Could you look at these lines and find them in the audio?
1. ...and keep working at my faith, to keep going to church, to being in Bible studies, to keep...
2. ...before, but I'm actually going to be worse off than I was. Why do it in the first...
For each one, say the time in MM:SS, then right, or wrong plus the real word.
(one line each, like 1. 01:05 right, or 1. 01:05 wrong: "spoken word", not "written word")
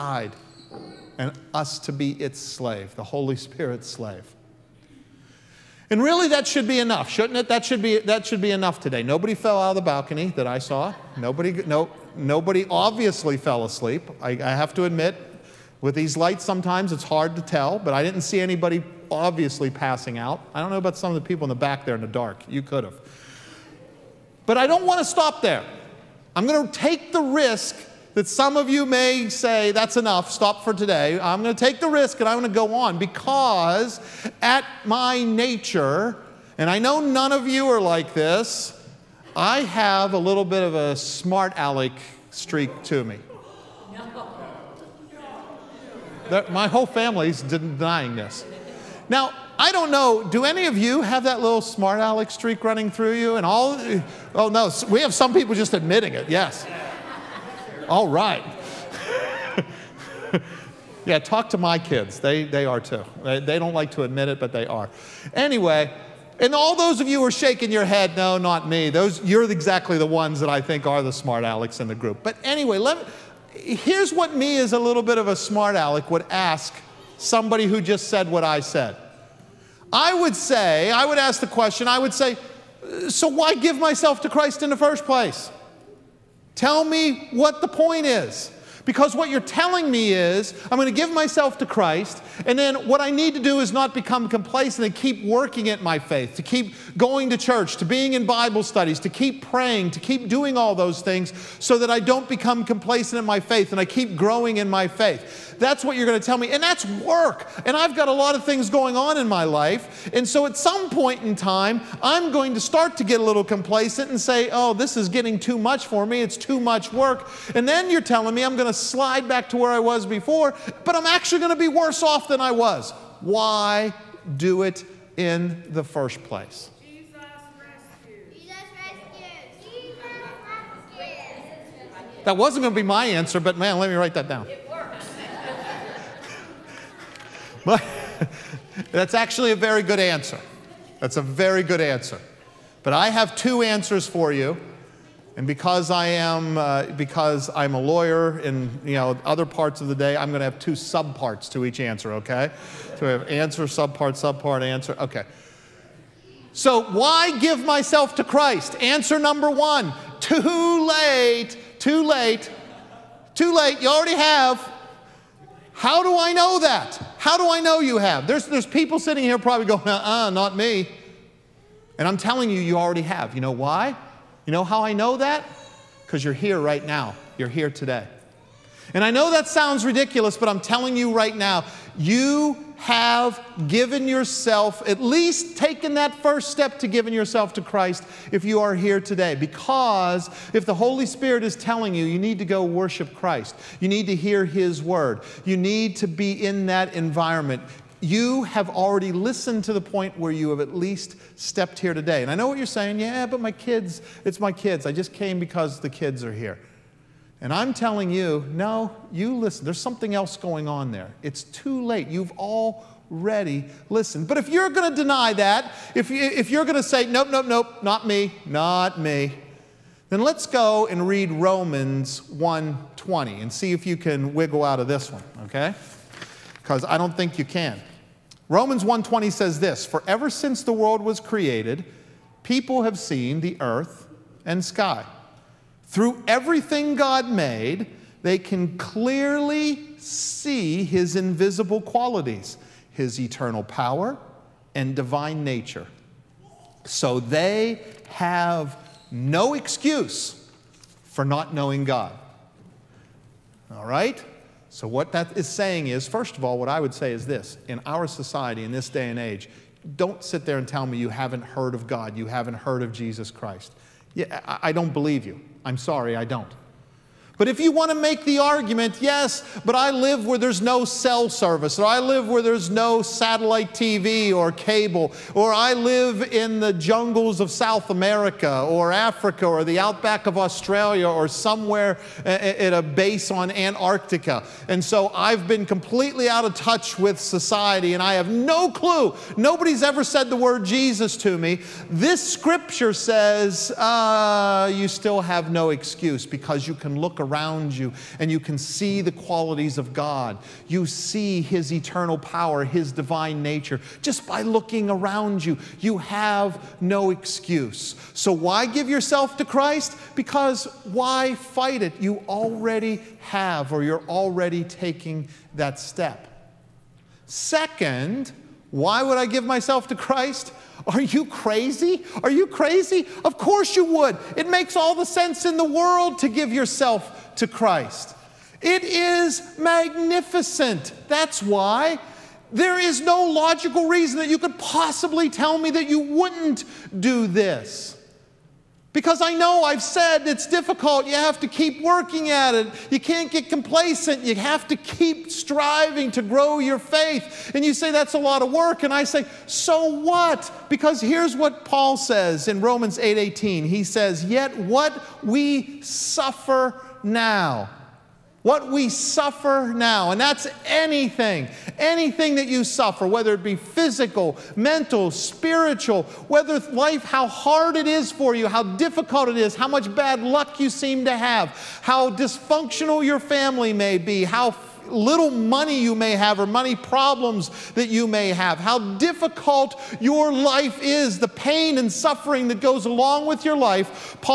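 1. 01:34 right
2. 02:00 right.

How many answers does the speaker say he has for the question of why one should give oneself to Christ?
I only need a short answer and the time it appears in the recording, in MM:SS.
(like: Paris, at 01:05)
2, at 02:23.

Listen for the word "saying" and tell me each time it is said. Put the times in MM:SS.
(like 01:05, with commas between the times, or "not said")
03:22, 04:15.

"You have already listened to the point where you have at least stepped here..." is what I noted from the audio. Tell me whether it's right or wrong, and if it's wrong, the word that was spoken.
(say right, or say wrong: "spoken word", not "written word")
right.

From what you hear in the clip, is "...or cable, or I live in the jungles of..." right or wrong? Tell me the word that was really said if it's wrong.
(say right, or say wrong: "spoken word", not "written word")
right.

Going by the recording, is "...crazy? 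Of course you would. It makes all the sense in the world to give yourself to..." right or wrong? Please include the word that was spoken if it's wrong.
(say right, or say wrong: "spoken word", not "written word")
right.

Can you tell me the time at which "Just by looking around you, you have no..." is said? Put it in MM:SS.
05:04.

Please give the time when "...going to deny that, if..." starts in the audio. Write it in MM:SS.
03:34.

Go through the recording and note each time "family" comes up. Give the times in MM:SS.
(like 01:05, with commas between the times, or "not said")
00:46, 06:13.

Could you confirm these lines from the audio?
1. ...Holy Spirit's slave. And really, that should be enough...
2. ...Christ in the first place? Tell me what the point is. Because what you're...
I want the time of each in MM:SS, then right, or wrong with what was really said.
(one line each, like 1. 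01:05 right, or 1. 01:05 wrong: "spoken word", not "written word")
1. 00:03 right
2. 01:24 right.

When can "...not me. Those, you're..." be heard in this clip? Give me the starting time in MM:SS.
01:08.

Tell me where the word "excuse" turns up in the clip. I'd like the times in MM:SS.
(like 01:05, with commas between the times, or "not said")
04:09, 04:55, 05:07.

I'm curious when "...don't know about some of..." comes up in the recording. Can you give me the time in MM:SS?
00:20.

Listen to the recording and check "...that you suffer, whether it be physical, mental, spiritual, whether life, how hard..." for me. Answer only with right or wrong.
right.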